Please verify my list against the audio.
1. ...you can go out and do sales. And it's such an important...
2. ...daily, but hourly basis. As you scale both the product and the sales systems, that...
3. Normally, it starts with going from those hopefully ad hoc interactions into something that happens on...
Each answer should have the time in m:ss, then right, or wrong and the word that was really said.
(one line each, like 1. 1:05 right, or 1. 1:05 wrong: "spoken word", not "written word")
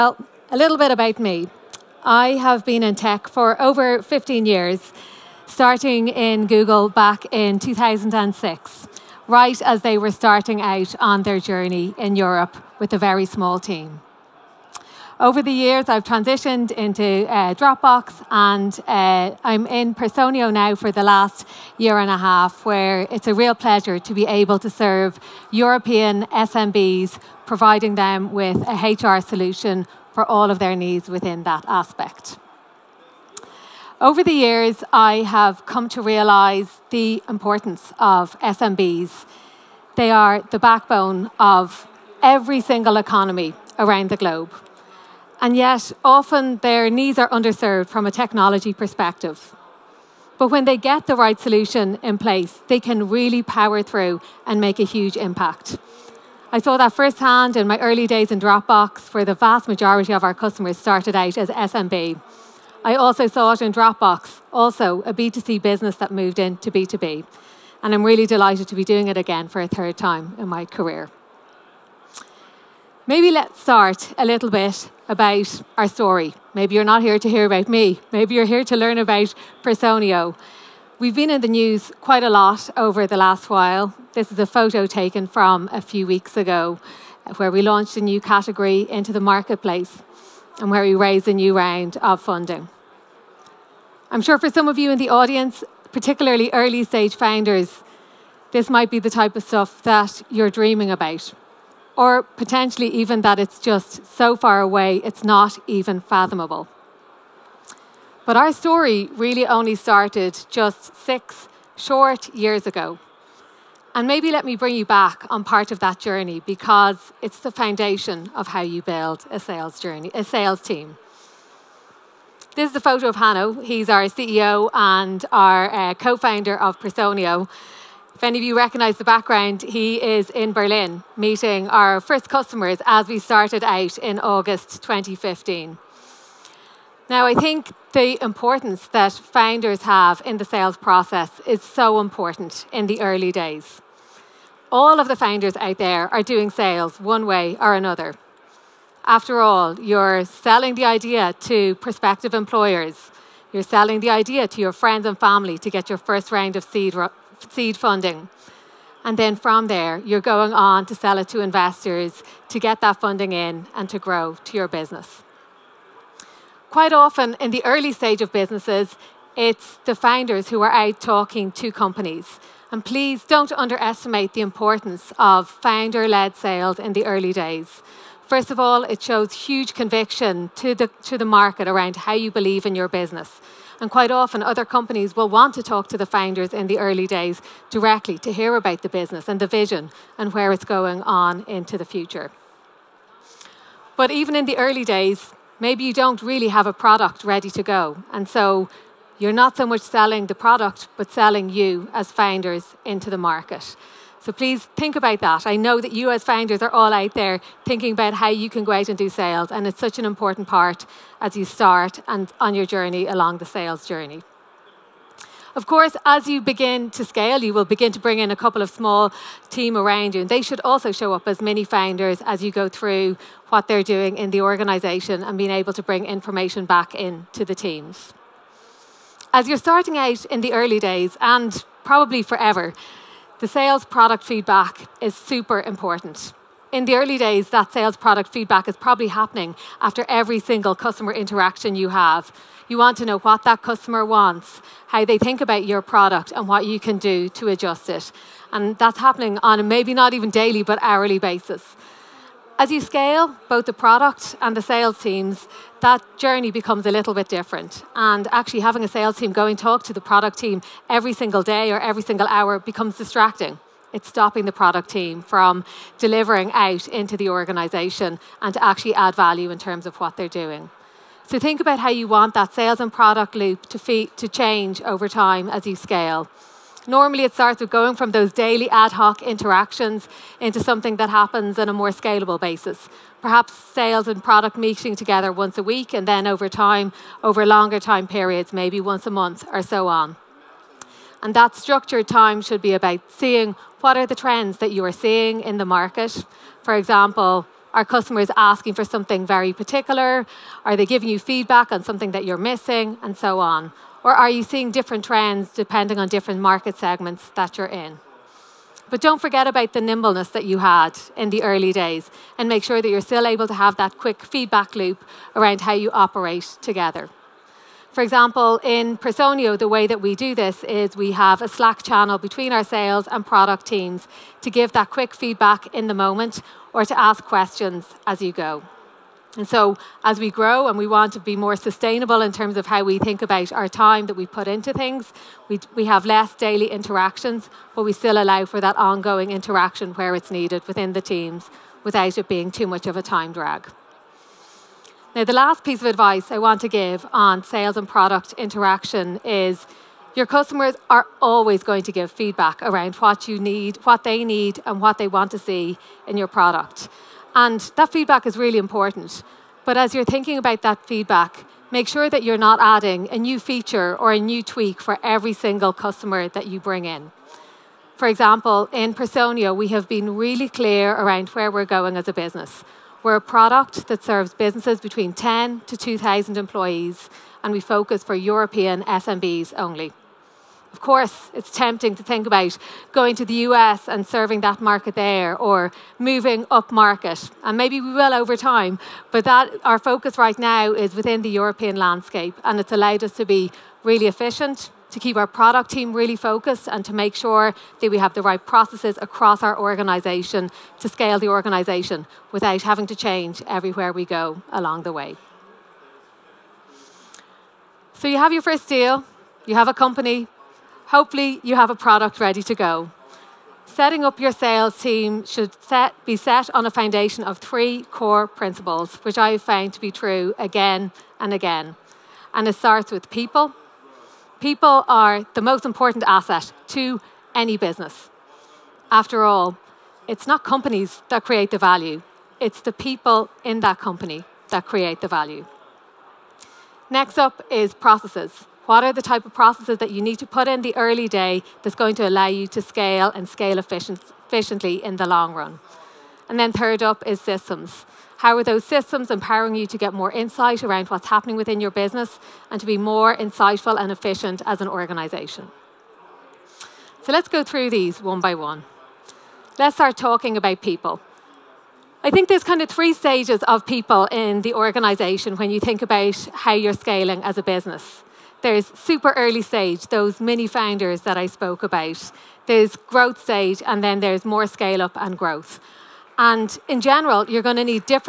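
1. 3:28 right
2. 4:10 wrong: "teams", not "systems"
3. 4:36 wrong: "daily", not "hopefully".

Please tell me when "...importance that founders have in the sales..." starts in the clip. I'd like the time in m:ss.
2:18.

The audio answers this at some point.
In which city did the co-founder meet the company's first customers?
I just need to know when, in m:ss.
2:10.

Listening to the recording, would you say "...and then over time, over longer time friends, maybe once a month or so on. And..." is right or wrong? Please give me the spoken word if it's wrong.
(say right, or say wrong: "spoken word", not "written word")
wrong: "periods", not "friends".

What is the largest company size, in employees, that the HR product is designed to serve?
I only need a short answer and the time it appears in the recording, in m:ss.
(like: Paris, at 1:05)
2,000, at 6:15.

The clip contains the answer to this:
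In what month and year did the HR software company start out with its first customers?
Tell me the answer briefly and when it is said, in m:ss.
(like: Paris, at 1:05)
August 2015, at 2:14.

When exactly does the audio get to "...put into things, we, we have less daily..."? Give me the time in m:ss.
5:34.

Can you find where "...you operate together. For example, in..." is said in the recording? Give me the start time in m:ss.
5:15.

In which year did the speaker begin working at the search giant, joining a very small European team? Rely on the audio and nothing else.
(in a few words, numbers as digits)
2006.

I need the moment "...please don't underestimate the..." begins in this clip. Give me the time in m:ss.
2:52.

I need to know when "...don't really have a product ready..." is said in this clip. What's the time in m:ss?
3:15.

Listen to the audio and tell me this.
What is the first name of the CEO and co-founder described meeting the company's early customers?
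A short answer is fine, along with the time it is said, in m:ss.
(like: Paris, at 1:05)
Hanno, at 2:03.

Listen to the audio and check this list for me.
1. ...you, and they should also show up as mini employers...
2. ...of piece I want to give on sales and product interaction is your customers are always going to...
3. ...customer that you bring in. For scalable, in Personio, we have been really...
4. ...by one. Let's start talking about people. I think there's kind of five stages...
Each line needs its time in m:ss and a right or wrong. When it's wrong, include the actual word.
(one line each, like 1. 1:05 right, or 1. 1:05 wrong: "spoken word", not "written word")
1. 3:40 wrong: "founders", not "employers"
2. 5:45 wrong: "advice", not "piece"
3. 6:05 wrong: "example", not "scalable"
4. 7:38 wrong: "three", not "five".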